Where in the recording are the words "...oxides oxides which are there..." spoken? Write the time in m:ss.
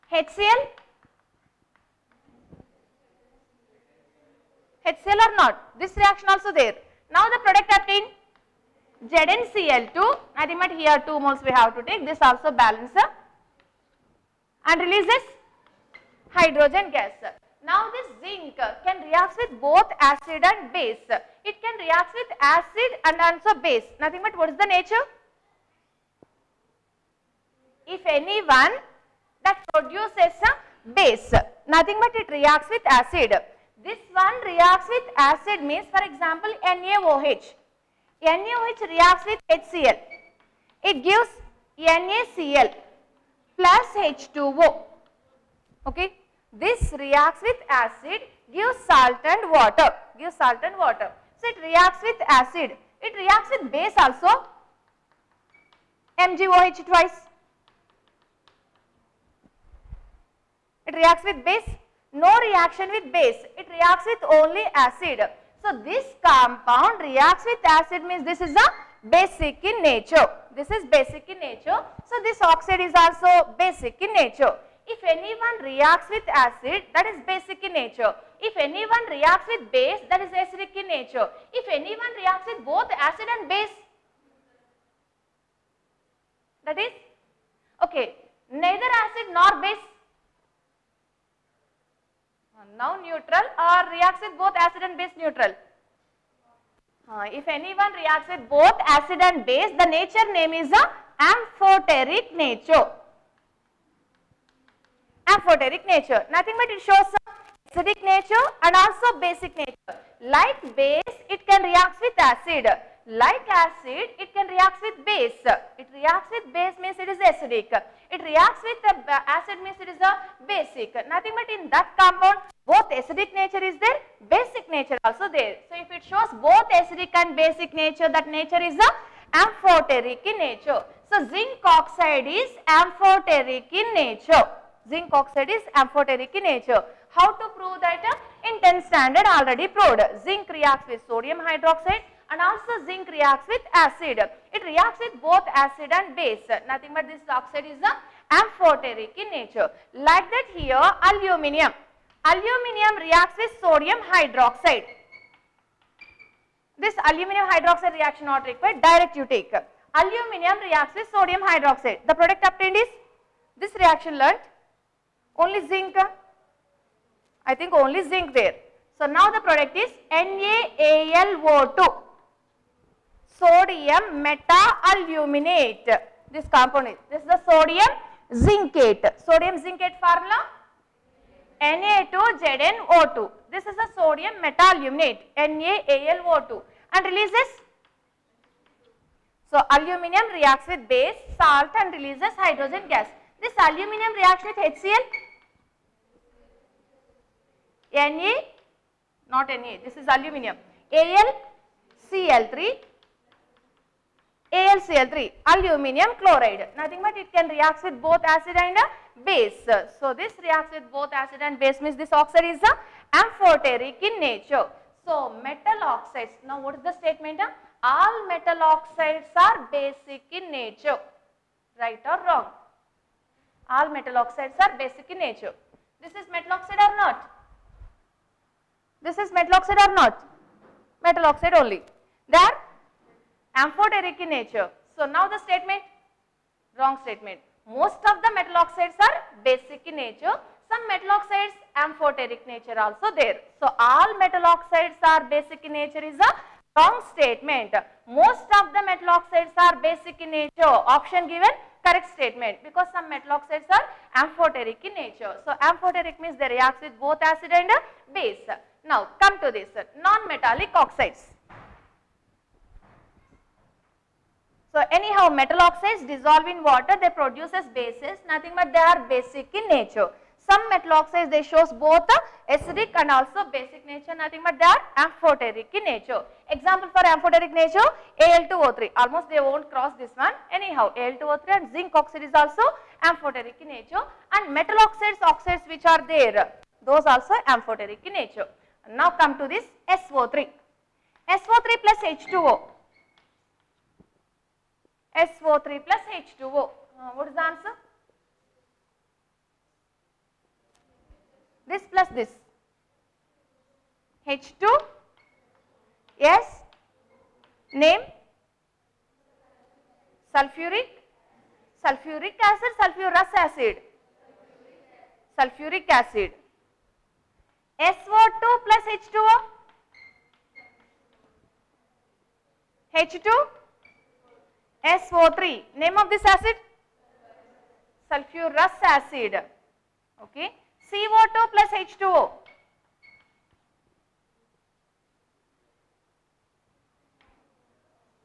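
4:44.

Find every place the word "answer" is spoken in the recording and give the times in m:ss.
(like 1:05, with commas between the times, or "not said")
4:57.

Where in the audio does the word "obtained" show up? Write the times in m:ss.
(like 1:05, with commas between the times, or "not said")
0:07, 2:42.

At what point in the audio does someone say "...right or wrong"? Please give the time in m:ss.
3:41.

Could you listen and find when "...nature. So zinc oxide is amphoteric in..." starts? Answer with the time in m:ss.
2:10.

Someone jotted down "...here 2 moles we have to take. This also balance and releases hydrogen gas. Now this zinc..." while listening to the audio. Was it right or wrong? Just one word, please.
right.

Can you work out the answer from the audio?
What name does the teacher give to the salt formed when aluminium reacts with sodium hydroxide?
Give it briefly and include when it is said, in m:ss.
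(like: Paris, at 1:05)
sodium meta-aluminate, at 3:03.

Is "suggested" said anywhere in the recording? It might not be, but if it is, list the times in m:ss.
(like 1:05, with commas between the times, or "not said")
not said.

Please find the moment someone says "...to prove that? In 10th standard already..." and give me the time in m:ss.
2:17.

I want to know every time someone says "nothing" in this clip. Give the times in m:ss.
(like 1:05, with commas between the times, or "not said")
0:23, 0:31, 1:46, 2:01, 2:26, 3:26, 4:28, 4:34.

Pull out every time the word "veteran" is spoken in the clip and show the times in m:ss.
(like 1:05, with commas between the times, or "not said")
not said.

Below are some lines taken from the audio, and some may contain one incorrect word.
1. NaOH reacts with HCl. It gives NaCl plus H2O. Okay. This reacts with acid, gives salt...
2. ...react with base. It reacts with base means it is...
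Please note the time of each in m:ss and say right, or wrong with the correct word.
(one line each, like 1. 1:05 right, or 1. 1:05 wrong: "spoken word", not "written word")
1. 0:38 right
2. 1:54 right.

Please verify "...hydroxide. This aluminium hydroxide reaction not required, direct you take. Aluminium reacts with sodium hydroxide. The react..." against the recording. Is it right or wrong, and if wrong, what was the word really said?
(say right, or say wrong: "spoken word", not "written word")
wrong: "product", not "react".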